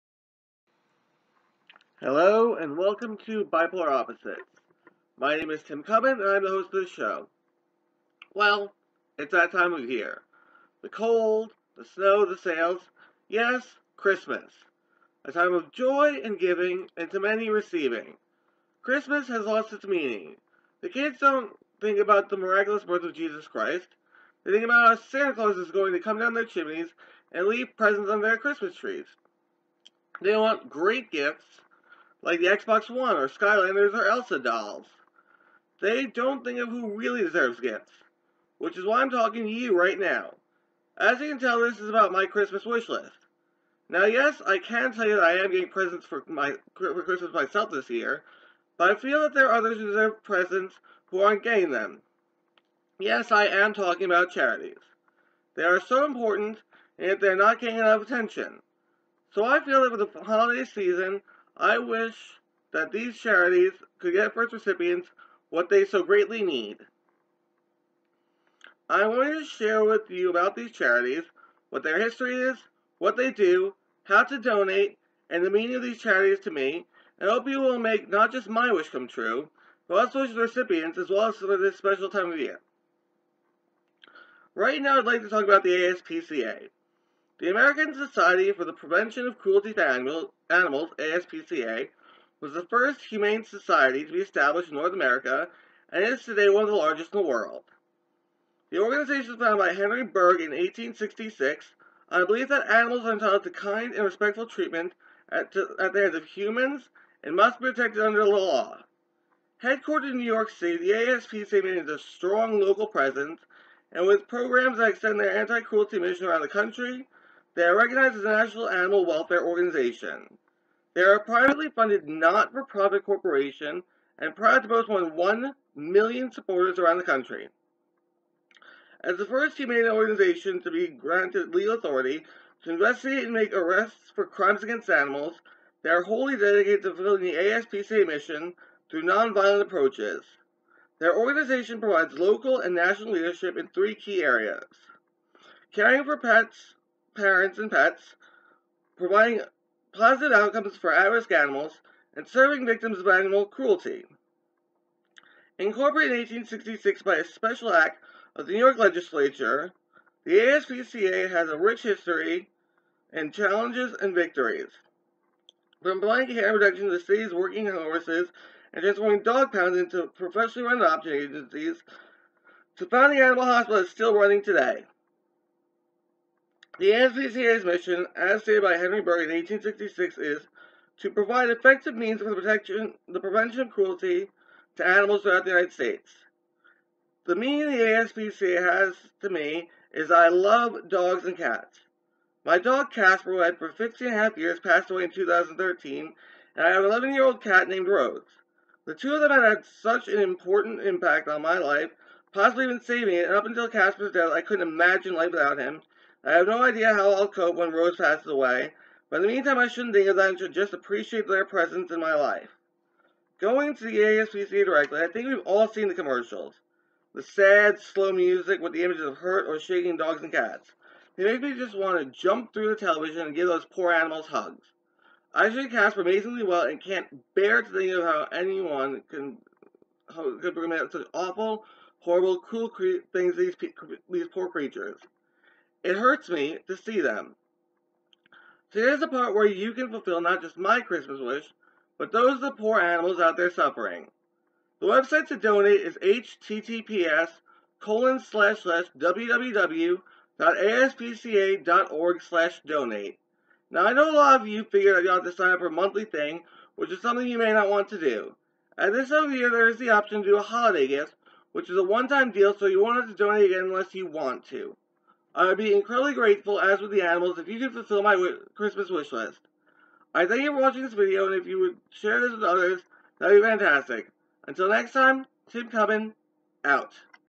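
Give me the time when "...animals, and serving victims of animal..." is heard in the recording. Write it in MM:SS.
02:31.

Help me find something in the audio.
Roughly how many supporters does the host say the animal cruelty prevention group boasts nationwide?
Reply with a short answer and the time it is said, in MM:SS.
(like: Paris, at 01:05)
more than 1 million, at 02:04.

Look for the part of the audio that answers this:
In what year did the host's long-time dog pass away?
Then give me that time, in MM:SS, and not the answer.
03:15.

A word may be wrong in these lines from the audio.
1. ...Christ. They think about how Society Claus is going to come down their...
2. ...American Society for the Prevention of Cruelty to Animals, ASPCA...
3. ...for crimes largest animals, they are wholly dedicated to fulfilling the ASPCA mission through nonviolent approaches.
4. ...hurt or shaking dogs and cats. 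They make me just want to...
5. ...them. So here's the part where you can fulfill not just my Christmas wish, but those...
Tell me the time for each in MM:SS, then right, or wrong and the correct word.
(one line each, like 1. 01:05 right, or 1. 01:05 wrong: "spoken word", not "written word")
1. 00:23 wrong: "Santa", not "Society"
2. 01:27 right
3. 02:14 wrong: "against", not "largest"
4. 03:39 right
5. 03:57 right.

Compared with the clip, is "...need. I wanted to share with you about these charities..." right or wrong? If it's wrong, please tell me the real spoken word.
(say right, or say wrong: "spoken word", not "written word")
right.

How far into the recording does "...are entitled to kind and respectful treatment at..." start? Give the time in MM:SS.
01:43.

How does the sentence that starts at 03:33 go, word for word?
Going to the ASPCA directly, I think we've all seen the commercials.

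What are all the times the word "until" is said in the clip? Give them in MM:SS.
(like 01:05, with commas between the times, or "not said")
03:23, 04:34.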